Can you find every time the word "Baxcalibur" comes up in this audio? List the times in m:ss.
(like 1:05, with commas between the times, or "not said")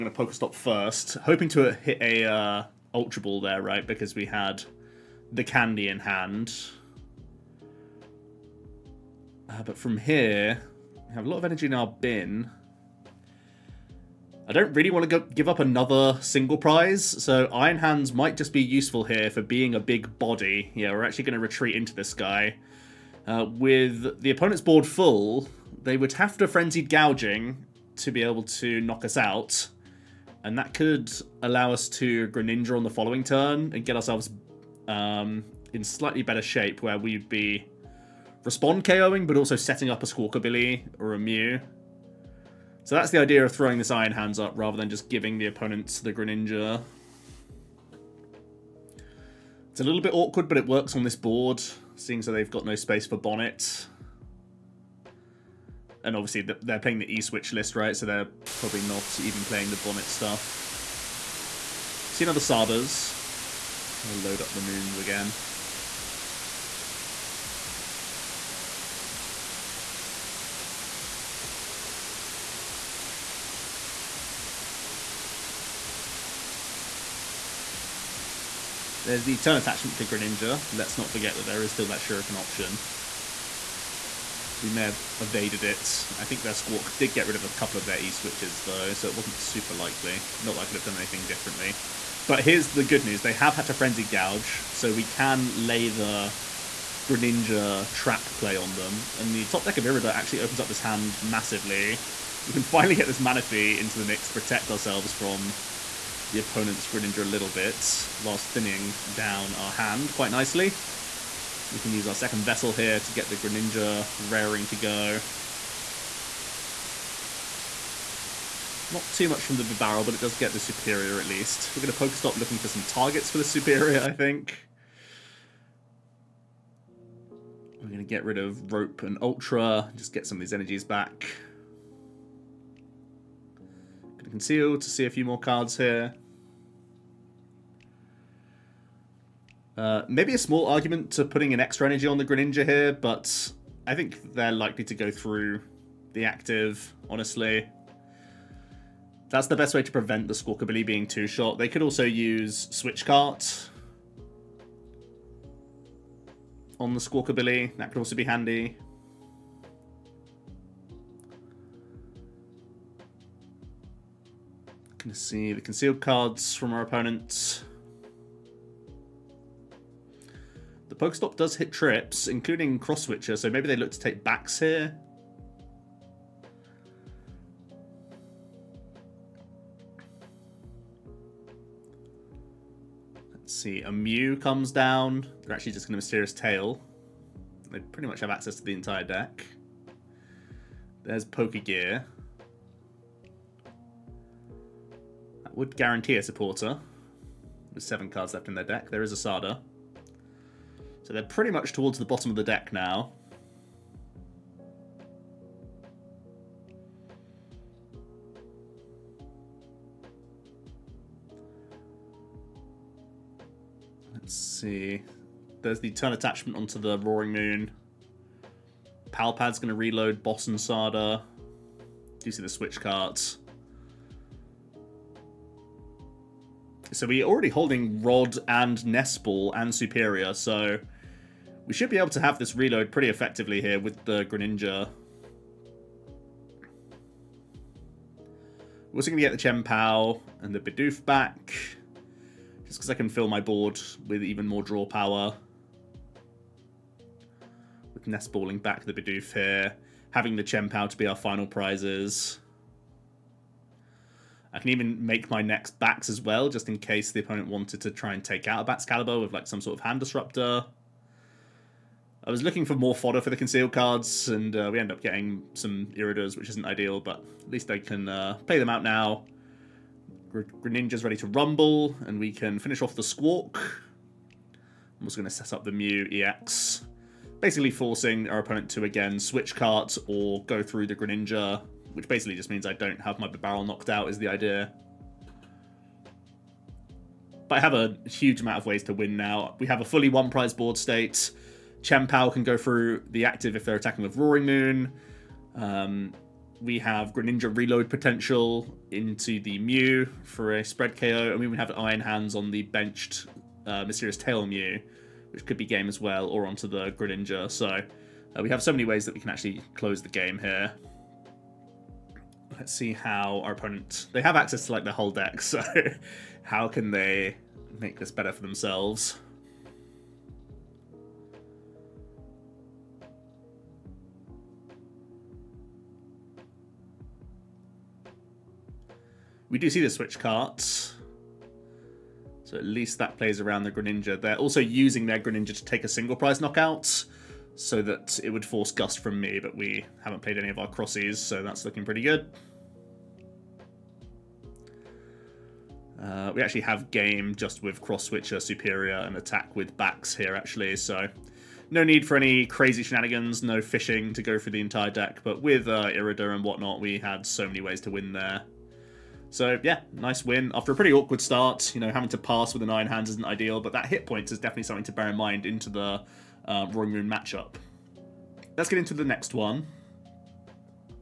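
4:18.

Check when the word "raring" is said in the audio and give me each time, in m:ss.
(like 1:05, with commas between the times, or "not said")
1:54.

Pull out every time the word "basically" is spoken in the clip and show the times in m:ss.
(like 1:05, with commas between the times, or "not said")
4:37, 4:42.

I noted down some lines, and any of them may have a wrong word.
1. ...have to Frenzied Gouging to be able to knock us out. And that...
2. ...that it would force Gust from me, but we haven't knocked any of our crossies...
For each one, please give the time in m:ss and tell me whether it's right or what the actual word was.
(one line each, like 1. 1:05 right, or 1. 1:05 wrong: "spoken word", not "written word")
1. 0:26 right
2. 5:37 wrong: "played", not "knocked".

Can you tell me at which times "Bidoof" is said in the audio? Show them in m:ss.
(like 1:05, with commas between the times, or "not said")
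4:00, 4:08.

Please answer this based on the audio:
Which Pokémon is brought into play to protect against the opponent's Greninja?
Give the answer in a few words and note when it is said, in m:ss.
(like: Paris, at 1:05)
Manaphy, at 1:43.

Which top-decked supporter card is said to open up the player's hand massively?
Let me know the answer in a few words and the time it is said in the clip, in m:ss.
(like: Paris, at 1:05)
Irida, at 1:39.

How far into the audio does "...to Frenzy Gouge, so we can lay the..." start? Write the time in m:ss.
1:33.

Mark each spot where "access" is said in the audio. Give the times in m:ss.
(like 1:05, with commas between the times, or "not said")
3:08, 5:14.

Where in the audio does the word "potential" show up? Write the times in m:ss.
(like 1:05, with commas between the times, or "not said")
4:57.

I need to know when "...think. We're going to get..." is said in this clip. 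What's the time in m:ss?
2:04.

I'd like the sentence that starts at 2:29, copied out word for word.
That's the best way to prevent the Squawkabilly being too short.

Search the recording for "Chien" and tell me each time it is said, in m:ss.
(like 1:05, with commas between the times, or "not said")
3:59, 4:10, 4:51.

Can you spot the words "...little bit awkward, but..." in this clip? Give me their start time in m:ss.
0:49.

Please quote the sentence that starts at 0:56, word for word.
And obviously they're playing the E-Switch list, right?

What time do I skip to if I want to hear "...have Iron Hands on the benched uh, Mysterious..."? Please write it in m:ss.
5:01.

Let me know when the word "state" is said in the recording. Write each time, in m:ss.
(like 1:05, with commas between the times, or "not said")
4:50.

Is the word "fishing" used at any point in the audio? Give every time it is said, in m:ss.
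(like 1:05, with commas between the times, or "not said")
5:53.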